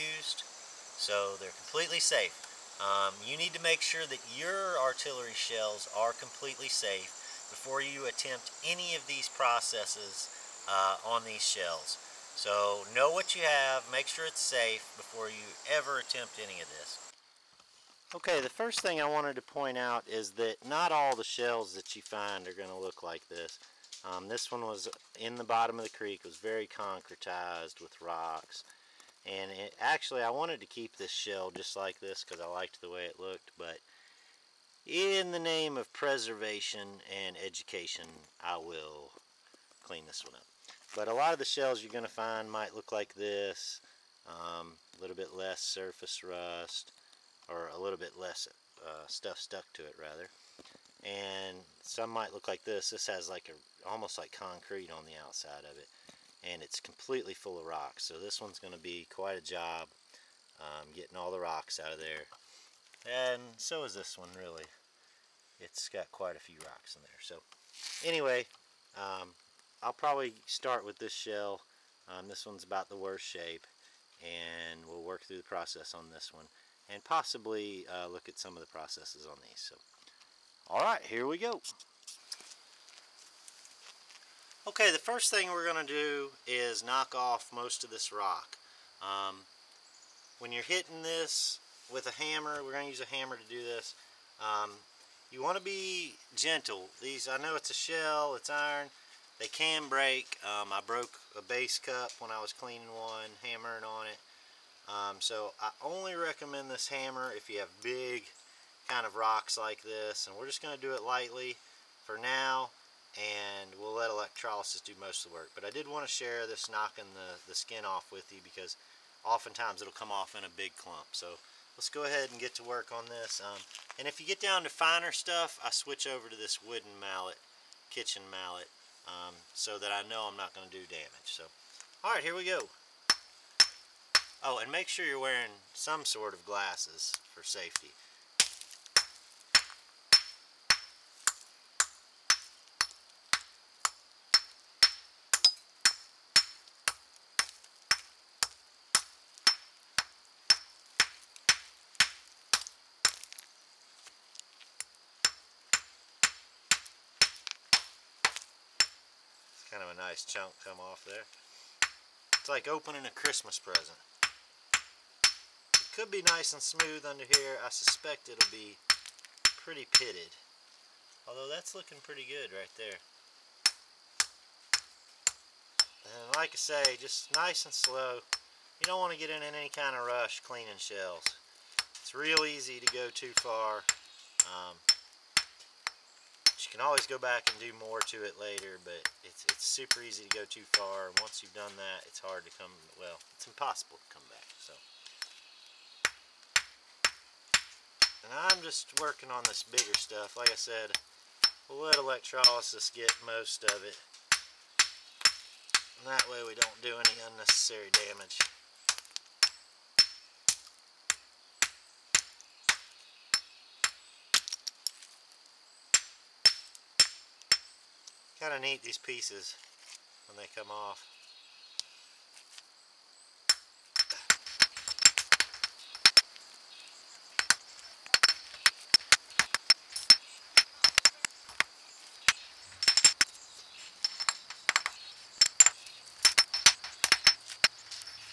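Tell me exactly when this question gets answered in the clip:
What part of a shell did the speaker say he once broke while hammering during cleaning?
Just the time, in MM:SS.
01:41.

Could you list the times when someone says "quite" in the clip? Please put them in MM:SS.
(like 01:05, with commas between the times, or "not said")
00:59, 01:06.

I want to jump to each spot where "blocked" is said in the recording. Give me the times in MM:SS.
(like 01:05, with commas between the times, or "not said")
not said.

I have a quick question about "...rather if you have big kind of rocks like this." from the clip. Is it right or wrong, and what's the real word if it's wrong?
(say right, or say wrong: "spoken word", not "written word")
wrong: "hammer", not "rather".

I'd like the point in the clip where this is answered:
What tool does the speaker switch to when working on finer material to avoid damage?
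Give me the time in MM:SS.
02:06.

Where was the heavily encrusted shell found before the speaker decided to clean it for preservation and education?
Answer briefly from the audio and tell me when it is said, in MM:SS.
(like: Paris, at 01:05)
Bottom of the creek, at 00:25.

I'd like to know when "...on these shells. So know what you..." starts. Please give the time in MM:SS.
00:11.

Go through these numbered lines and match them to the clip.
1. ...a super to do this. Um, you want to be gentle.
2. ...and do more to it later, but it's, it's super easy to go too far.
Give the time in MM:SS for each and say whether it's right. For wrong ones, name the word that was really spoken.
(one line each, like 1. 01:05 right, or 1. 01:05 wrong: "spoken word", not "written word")
1. 01:32 wrong: "hammer", not "super"
2. 03:07 right.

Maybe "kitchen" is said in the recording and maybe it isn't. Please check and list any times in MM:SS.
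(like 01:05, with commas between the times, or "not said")
02:07.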